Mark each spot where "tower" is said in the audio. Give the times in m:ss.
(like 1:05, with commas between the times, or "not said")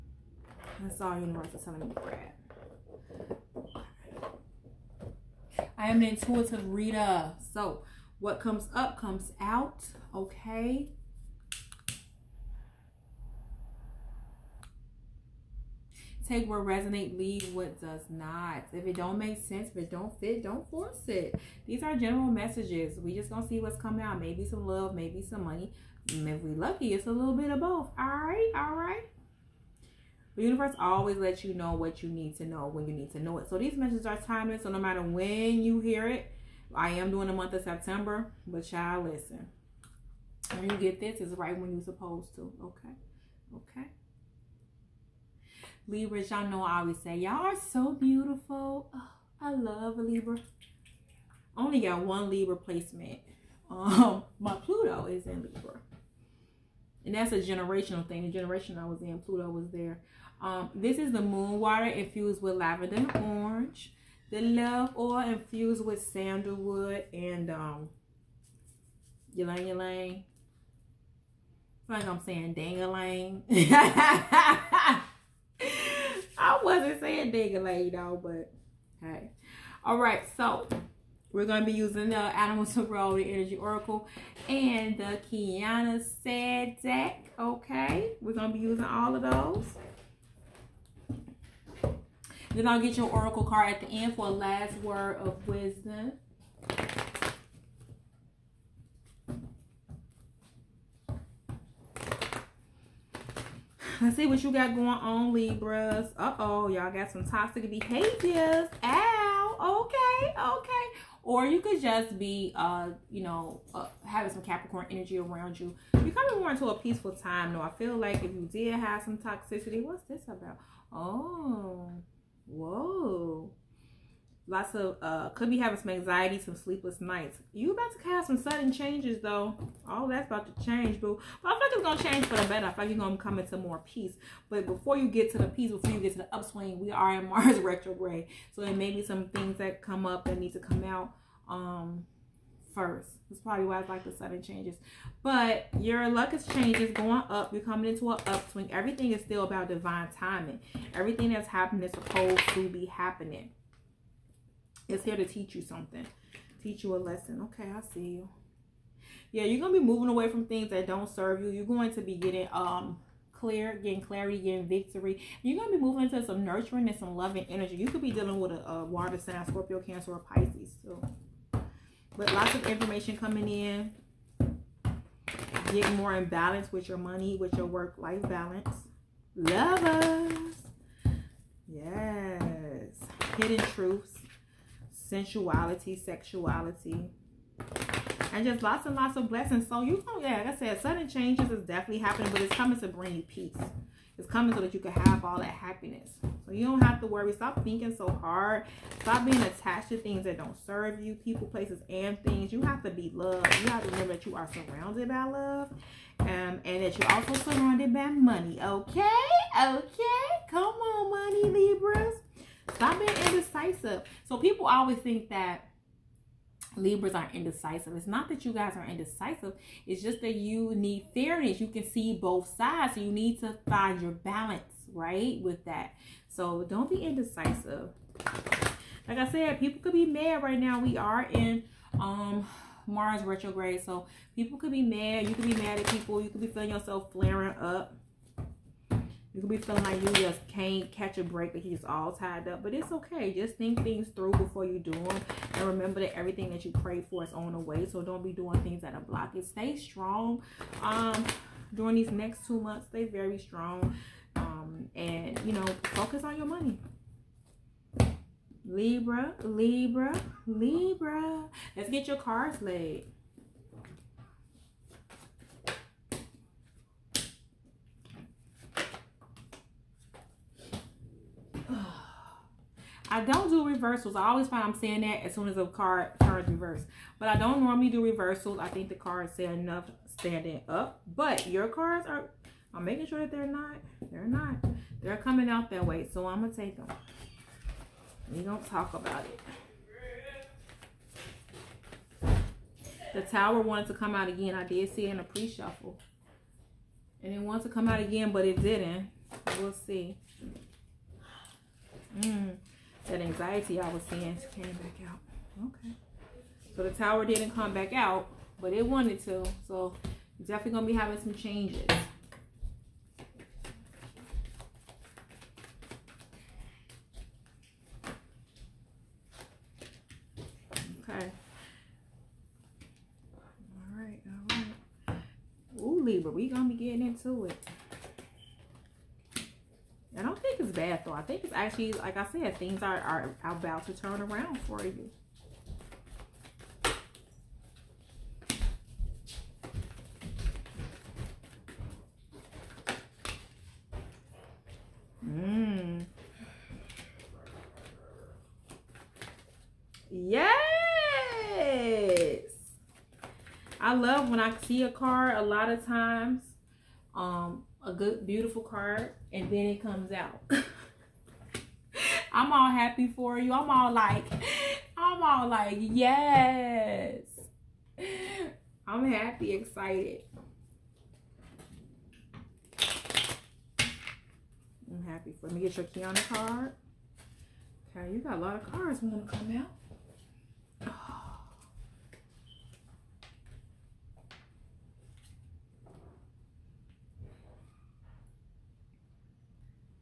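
4:53, 5:06.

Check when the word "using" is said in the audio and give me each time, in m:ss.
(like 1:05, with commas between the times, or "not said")
1:21, 1:28.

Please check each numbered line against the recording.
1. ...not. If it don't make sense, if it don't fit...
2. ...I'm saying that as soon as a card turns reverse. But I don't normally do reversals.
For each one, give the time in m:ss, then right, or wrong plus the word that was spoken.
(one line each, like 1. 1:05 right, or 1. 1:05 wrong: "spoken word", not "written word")
1. 0:18 right
2. 4:34 right.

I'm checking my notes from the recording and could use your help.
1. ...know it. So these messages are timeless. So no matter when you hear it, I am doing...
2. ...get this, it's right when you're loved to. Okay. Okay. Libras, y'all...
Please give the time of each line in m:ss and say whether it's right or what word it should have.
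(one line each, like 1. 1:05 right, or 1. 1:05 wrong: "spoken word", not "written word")
1. 0:33 right
2. 0:40 wrong: "supposed", not "loved".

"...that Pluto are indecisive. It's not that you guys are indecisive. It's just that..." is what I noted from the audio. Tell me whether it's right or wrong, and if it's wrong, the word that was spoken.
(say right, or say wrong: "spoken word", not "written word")
wrong: "Libras", not "Pluto".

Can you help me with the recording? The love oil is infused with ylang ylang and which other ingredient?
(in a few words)
sandalwood.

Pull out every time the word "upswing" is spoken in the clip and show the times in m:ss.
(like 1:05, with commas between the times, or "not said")
2:16, 2:28.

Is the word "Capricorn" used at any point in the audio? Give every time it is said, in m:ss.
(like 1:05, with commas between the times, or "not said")
1:54.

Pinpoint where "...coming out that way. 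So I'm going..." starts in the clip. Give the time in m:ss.
4:45.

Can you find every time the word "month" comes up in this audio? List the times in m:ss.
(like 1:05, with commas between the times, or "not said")
0:37, 4:12.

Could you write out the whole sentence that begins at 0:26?
And mm, if we lucky, it's a little bit of both.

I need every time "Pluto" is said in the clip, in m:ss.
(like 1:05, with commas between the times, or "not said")
0:54, 0:59.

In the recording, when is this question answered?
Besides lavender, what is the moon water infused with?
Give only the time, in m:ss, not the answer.
1:02.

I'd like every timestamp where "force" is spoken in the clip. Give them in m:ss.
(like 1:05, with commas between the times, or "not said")
0:20.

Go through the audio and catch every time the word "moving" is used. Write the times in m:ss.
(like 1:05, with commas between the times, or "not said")
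2:39, 2:45.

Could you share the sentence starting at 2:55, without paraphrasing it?
Get more in balance with your money, with your work-life balance.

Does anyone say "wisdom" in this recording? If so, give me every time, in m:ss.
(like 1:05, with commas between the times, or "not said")
1:35.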